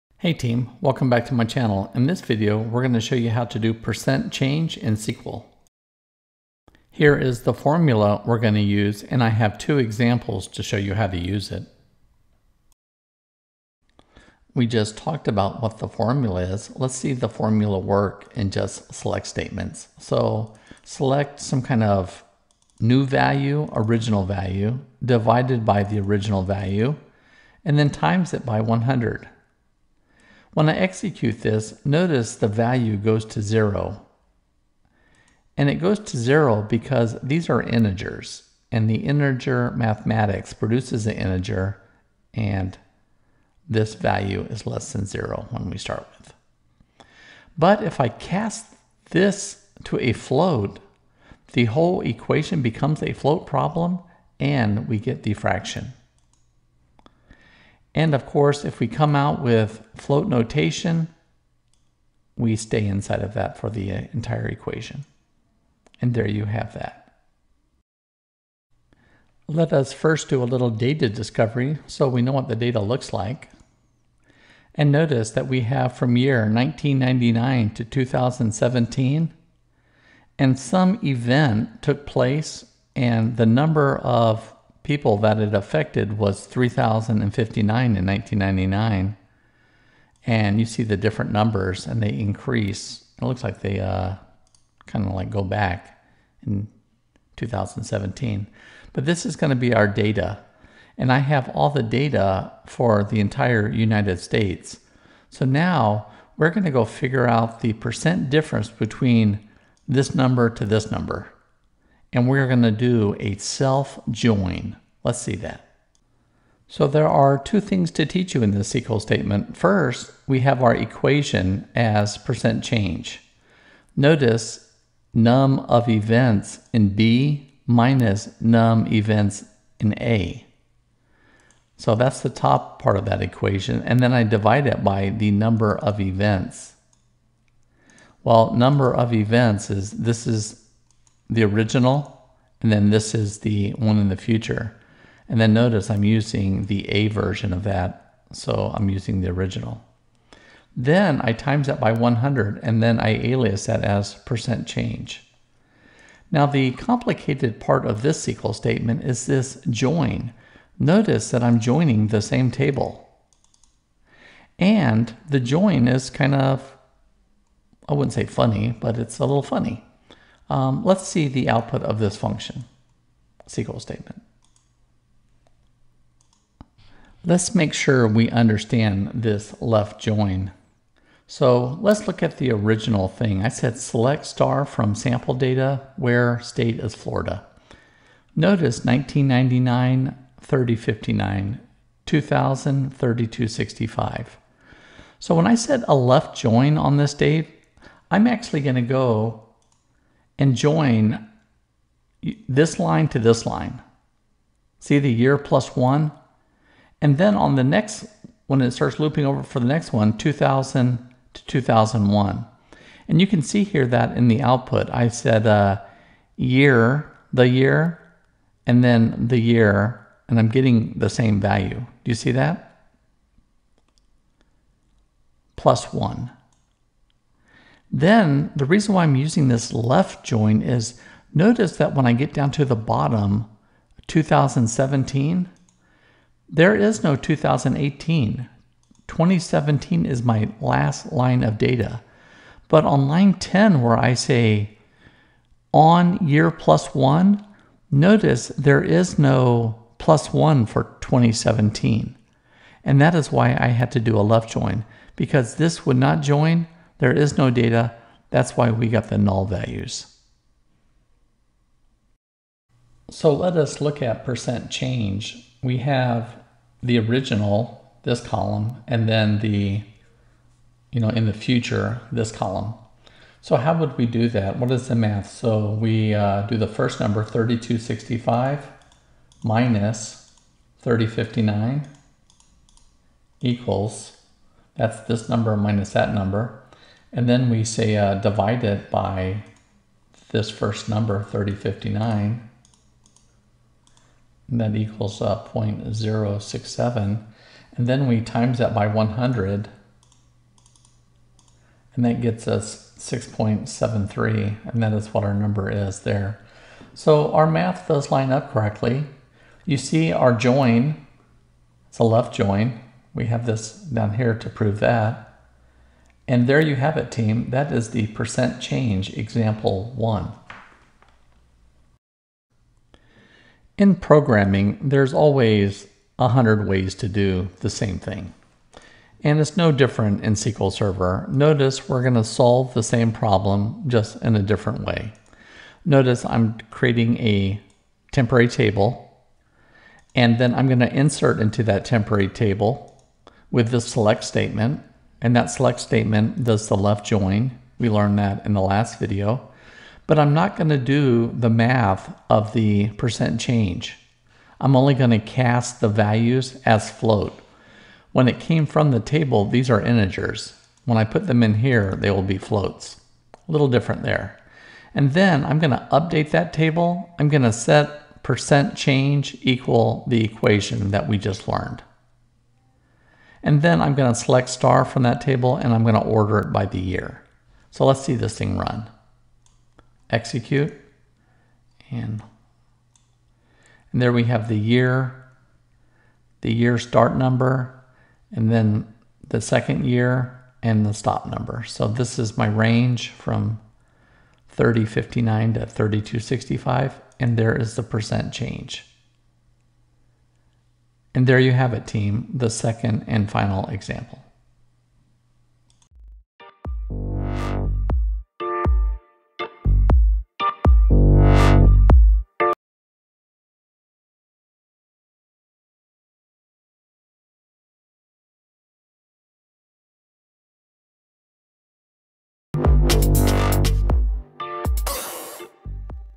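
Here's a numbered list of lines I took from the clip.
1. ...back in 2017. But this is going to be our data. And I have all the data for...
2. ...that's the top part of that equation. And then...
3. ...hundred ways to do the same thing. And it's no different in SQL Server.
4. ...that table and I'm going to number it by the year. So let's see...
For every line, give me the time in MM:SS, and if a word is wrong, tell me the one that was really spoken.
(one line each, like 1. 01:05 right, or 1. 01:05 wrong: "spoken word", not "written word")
1. 01:35 right
2. 02:11 right
3. 05:26 right
4. 06:15 wrong: "order", not "number".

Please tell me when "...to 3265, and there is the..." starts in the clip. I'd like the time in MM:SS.
06:35.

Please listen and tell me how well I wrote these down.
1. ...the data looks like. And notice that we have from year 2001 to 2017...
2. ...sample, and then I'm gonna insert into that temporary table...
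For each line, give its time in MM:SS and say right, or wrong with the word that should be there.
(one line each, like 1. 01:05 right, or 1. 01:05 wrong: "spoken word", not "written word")
1. 01:12 wrong: "1999", not "2001"
2. 05:38 wrong: "table", not "sample".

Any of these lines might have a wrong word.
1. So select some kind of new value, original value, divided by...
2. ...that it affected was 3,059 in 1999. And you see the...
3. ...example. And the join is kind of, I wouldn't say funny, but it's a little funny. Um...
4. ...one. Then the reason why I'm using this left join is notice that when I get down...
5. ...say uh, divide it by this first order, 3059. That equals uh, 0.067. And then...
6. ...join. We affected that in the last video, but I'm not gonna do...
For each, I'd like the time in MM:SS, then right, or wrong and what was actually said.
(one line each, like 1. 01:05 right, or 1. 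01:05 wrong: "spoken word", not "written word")
1. 00:19 right
2. 01:25 right
3. 02:42 wrong: "table", not "example"
4. 03:45 right
5. 04:47 wrong: "number", not "order"
6. 05:47 wrong: "learned", not "affected".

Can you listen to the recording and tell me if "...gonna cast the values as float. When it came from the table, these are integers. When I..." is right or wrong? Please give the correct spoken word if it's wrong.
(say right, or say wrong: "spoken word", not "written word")
right.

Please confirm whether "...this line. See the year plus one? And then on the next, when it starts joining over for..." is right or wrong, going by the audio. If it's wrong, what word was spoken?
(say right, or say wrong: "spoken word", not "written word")
wrong: "looping", not "joining".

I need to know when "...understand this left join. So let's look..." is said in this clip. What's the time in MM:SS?
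02:58.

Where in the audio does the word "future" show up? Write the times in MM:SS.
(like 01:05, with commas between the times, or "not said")
02:24, 04:31.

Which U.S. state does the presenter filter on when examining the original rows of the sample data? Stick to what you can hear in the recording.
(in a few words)
Florida.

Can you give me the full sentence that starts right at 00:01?
In this video, we're going to show you how to do percent change in SQL.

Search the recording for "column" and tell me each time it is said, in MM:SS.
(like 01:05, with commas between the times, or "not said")
04:28, 04:32.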